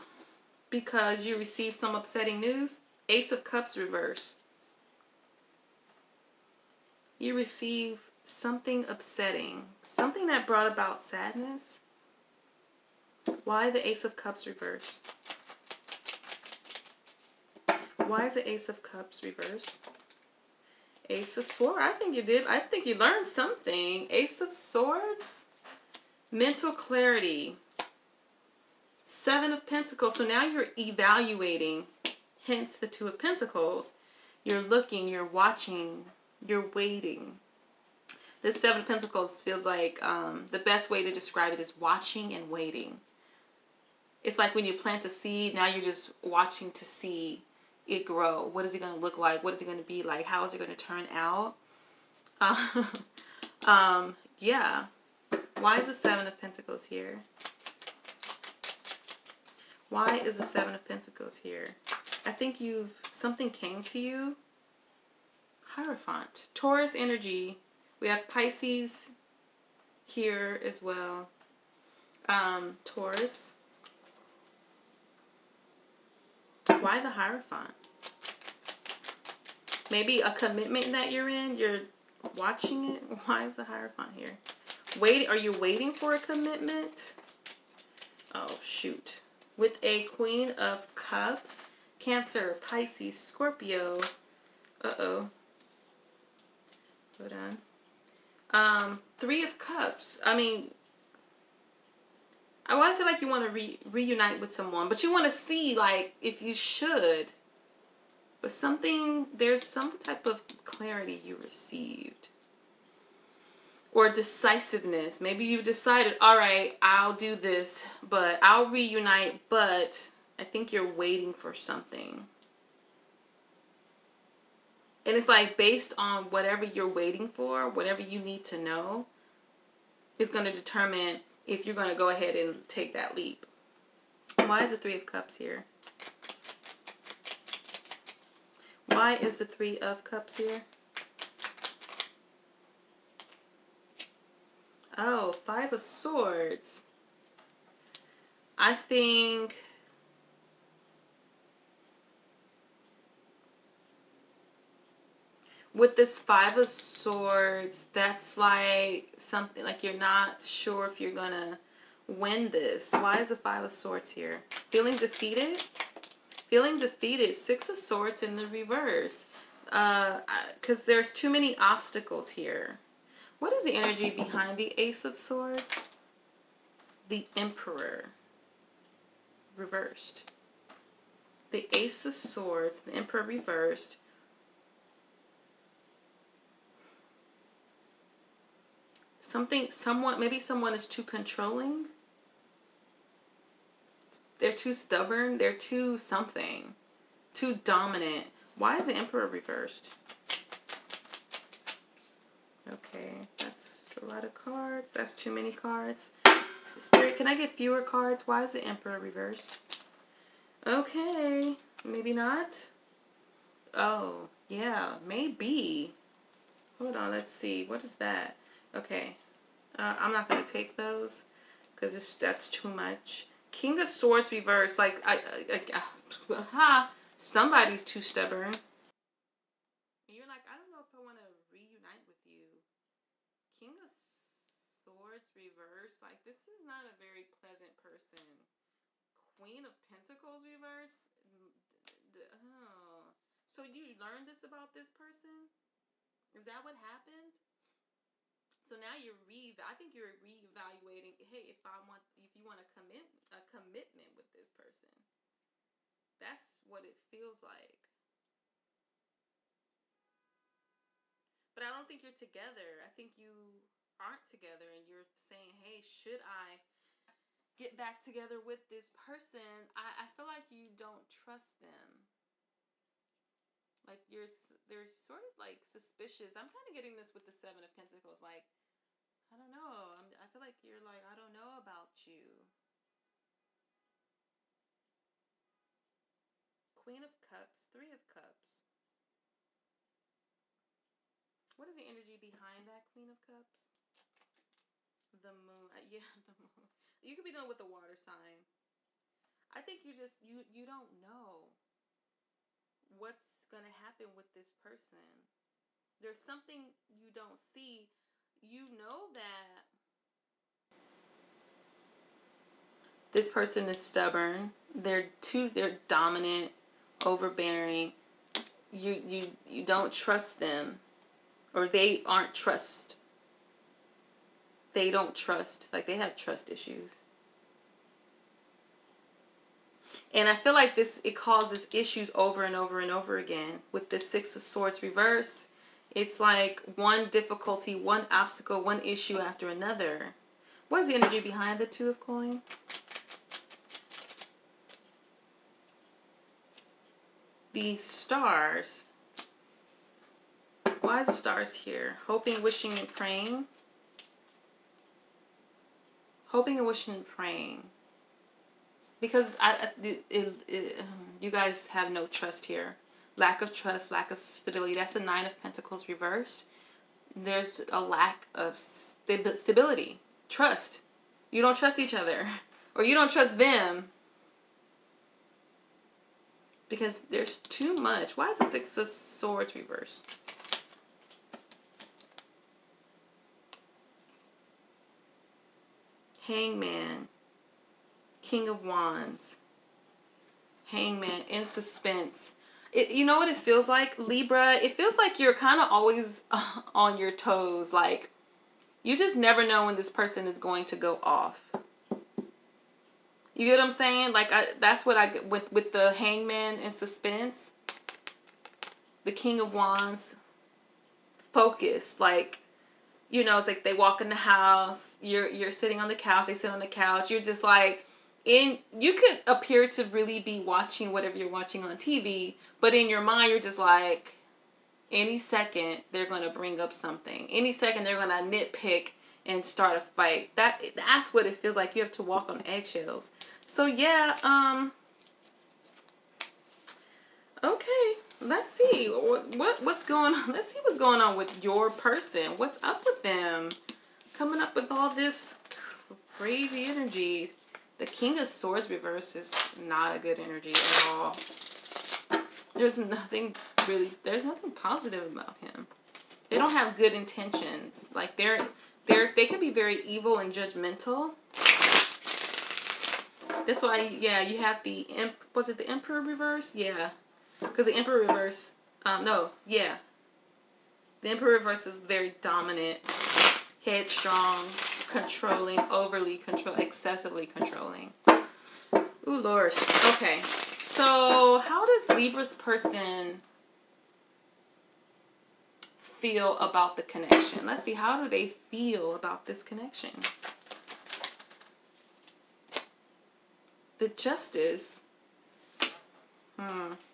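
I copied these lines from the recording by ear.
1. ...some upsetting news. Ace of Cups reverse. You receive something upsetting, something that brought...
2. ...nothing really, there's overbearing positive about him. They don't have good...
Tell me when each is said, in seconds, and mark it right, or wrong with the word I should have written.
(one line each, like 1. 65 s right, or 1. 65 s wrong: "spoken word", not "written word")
1. 1 s right
2. 452 s wrong: "nothing", not "overbearing".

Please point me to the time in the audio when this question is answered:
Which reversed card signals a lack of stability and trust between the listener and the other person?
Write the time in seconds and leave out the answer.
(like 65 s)
364 s.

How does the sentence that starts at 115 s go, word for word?
Maybe you've decided, all right, I'll do this, but I'll reunite, but I think you're waiting for something.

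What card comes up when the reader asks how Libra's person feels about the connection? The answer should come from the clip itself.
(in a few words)
Justice.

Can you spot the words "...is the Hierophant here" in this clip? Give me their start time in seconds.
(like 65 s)
83 s.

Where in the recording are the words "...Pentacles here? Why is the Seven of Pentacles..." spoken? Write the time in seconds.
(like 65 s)
56 s.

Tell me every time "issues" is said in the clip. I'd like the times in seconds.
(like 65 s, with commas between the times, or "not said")
326 s, 331 s, 338 s.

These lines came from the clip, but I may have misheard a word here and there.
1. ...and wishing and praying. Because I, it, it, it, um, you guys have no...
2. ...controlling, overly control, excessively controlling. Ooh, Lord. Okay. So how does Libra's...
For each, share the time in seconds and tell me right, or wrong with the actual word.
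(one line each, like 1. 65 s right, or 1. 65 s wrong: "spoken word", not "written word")
1. 356 s right
2. 474 s right.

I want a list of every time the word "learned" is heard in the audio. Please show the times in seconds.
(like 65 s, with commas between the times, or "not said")
22 s, 243 s.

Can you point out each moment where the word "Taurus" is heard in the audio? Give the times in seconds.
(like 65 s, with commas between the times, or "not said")
66 s, 72 s.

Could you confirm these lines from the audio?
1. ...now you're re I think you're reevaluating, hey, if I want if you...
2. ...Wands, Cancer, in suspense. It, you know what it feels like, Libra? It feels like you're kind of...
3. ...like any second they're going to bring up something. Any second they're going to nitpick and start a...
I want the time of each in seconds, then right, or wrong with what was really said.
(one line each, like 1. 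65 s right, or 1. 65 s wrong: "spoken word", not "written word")
1. 248 s right
2. 388 s wrong: "Hangman", not "Cancer"
3. 423 s right.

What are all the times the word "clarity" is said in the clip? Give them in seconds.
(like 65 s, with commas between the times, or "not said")
26 s, 110 s.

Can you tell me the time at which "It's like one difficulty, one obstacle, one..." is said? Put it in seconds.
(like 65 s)
335 s.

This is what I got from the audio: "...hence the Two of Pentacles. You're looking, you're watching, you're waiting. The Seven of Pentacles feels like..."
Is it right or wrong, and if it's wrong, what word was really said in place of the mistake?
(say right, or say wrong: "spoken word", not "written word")
right.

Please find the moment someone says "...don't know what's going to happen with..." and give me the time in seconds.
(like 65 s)
300 s.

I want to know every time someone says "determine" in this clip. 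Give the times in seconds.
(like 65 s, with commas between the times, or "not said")
130 s.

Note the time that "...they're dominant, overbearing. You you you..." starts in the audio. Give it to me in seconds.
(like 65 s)
315 s.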